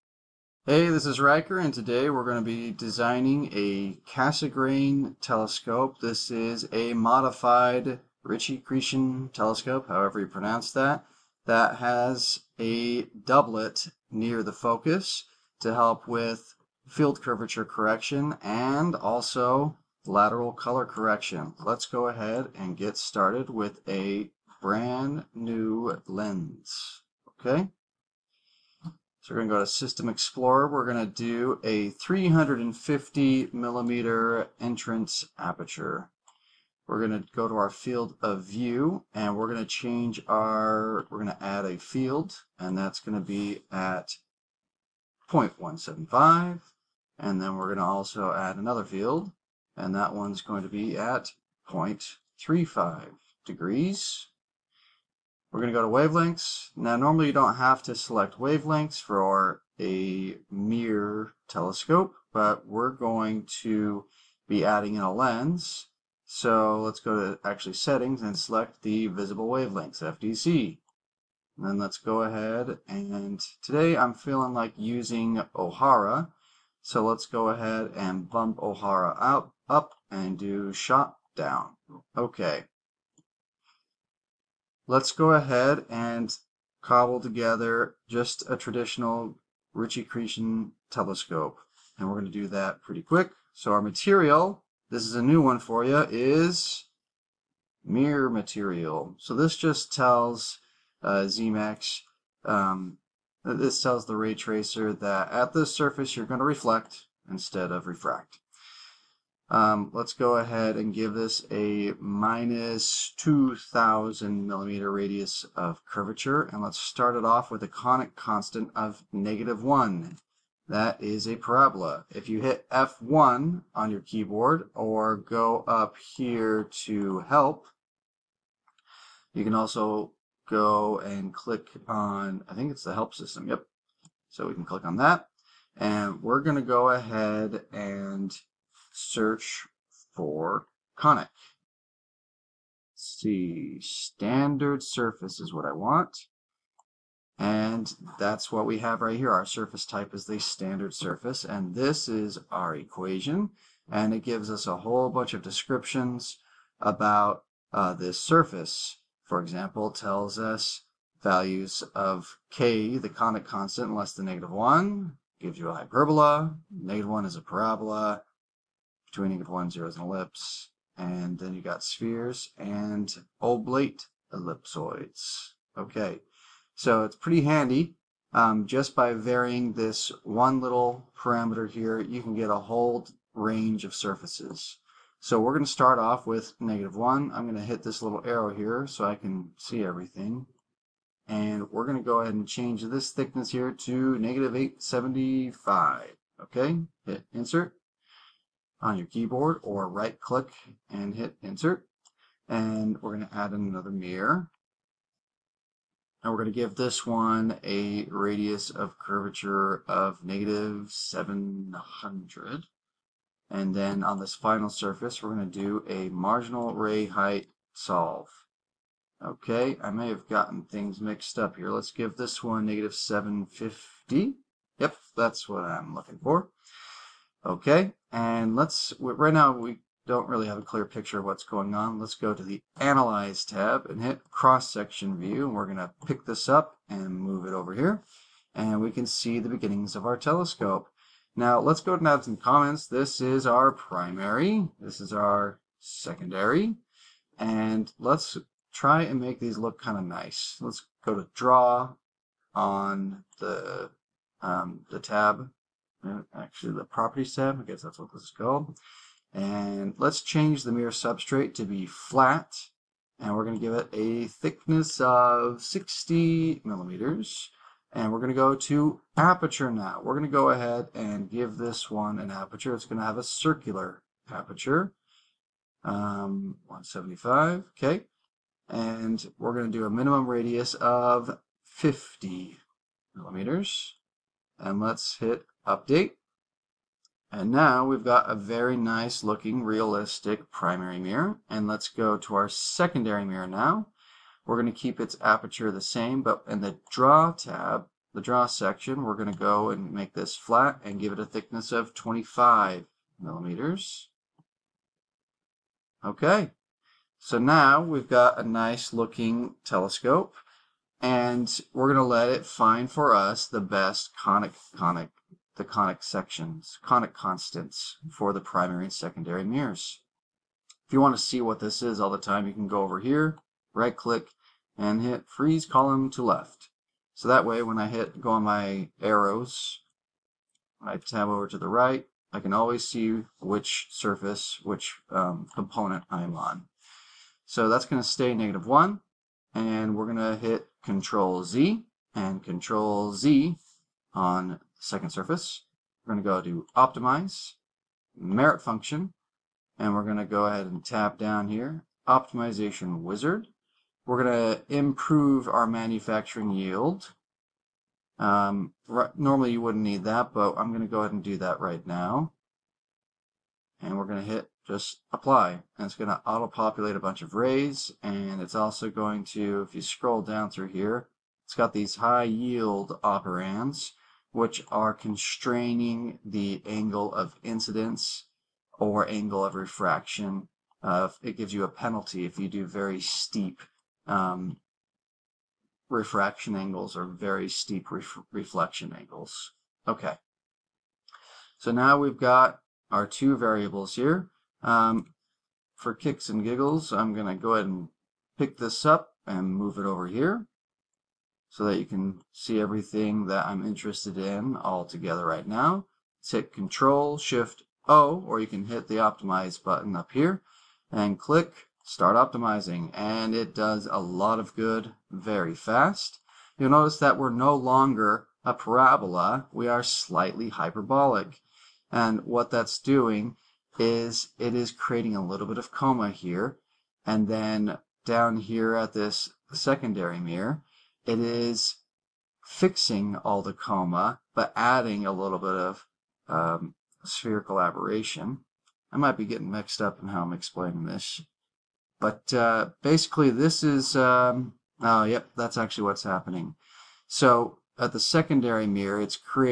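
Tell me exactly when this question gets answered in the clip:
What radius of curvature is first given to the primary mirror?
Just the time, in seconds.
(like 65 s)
111 s.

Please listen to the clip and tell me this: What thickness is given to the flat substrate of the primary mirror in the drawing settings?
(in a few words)
60 mm.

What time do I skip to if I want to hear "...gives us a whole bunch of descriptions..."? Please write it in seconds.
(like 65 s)
154 s.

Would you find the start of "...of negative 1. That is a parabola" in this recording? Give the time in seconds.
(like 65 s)
118 s.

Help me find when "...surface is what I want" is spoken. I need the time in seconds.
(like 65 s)
144 s.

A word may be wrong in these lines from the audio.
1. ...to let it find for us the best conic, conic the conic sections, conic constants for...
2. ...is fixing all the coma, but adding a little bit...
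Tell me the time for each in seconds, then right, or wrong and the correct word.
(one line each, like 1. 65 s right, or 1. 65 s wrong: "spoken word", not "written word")
1. 311 s right
2. 431 s right.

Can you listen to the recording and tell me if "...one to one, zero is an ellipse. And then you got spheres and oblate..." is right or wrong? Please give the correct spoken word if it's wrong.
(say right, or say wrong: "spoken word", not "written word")
right.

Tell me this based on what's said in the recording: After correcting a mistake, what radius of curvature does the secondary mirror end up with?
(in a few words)
-750.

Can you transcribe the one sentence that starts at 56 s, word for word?
Now, normally you don't have to select wavelengths for a mirror telescope, but we're going to be adding in a lens.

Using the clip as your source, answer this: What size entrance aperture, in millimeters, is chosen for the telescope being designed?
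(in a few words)
350 mm.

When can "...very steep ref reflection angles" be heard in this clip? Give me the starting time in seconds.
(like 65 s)
387 s.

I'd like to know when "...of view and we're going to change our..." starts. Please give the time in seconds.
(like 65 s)
38 s.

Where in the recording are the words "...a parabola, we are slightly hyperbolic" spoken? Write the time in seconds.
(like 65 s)
418 s.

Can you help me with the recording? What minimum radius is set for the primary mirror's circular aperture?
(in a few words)
50 mm.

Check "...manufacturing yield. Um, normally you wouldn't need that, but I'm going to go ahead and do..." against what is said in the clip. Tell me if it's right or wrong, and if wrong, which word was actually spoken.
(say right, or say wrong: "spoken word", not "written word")
right.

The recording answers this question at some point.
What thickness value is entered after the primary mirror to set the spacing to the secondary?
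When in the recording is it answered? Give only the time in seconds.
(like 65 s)
194 s.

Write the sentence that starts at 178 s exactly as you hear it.
Um, just by varying this one little parameter here, you can get a whole range of surfaces.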